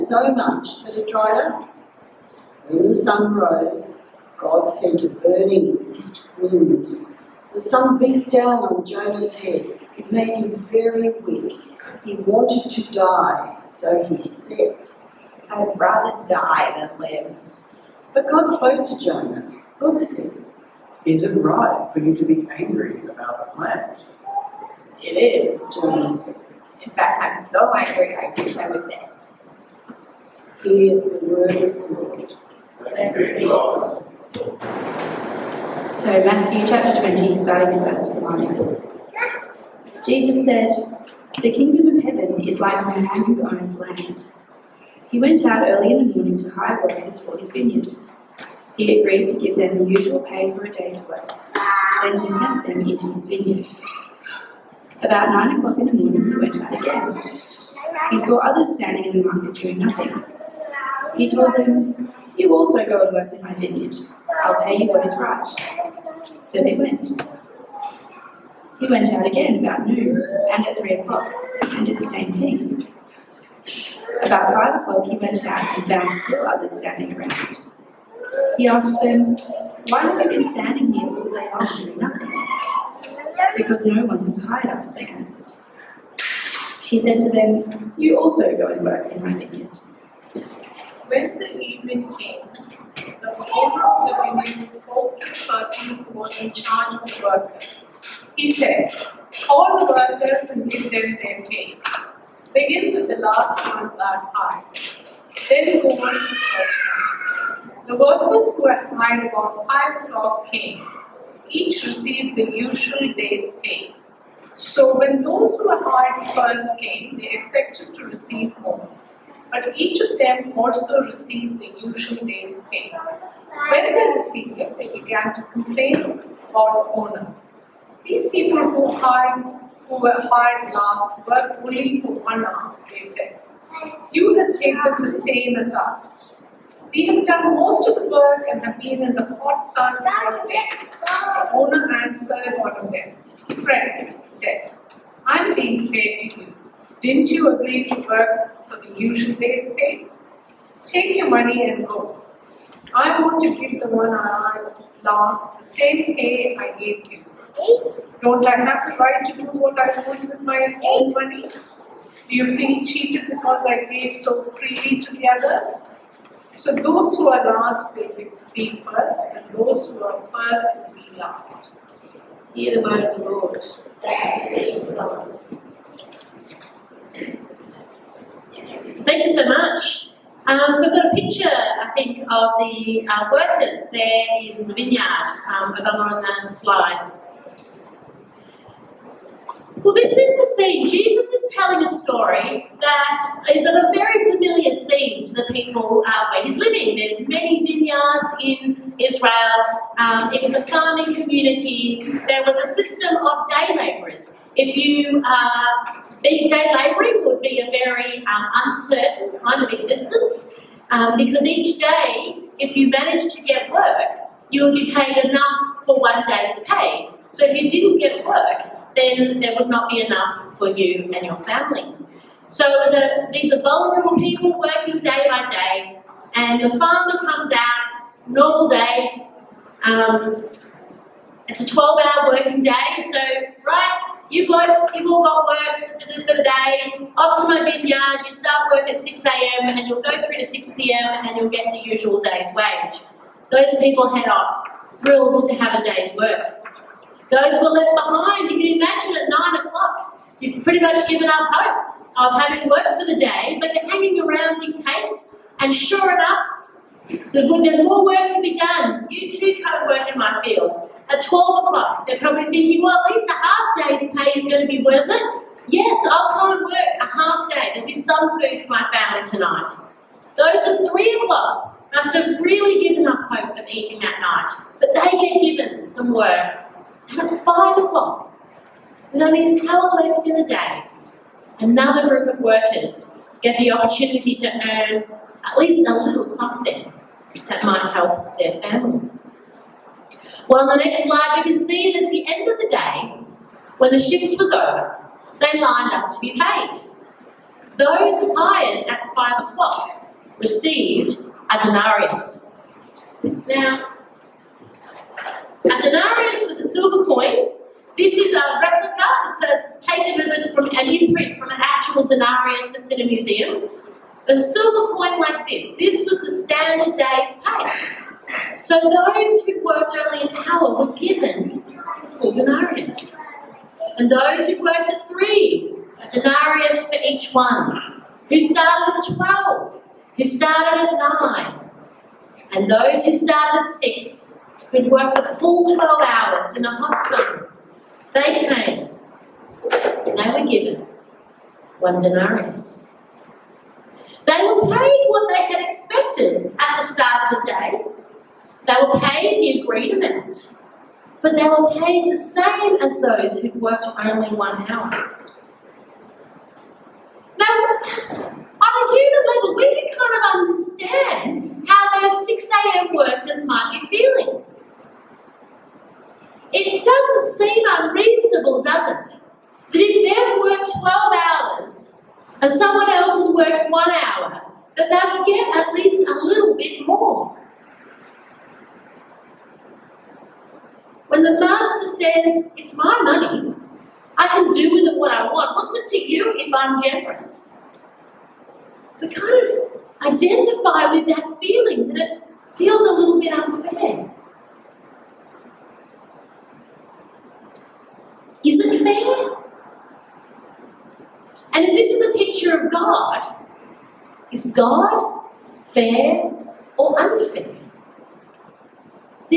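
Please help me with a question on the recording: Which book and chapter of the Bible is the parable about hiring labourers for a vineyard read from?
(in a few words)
Matthew chapter 20.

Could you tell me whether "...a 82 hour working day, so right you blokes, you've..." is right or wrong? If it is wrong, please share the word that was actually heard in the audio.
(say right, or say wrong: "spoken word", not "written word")
wrong: "12", not "82".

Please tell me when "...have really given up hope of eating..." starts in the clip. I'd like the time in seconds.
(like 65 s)
272 s.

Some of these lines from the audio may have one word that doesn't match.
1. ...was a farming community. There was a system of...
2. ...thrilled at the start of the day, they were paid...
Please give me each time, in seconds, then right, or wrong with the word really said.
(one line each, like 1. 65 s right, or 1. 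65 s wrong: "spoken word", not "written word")
1. 200 s right
2. 345 s wrong: "expected", not "thrilled".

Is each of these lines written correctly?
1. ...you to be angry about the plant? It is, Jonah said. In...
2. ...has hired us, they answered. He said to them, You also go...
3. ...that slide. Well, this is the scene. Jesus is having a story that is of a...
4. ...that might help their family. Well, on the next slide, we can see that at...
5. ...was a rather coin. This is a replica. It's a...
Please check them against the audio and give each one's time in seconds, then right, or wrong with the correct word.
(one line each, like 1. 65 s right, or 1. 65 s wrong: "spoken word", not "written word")
1. 22 s right
2. 84 s right
3. 186 s wrong: "telling", not "having"
4. 287 s right
5. 306 s wrong: "silver", not "rather".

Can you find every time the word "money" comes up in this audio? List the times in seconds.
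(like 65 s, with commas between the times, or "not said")
151 s, 161 s, 383 s.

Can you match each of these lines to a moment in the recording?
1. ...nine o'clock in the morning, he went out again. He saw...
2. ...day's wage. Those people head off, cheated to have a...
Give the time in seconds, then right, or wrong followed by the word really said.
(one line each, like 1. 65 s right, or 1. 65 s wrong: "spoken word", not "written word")
1. 55 s right
2. 242 s wrong: "thrilled", not "cheated".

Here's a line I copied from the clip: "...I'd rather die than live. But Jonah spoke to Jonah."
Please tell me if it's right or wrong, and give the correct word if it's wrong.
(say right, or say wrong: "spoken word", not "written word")
wrong: "God", not "Jonah".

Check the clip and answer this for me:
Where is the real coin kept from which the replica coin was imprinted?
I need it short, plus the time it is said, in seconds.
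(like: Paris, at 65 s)
a museum, at 313 s.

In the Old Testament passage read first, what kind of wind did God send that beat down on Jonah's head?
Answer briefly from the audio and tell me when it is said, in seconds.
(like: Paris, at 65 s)
a burning east wind, at 5 s.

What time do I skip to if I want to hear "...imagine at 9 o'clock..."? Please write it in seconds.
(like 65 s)
248 s.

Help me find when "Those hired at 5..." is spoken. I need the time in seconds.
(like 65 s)
297 s.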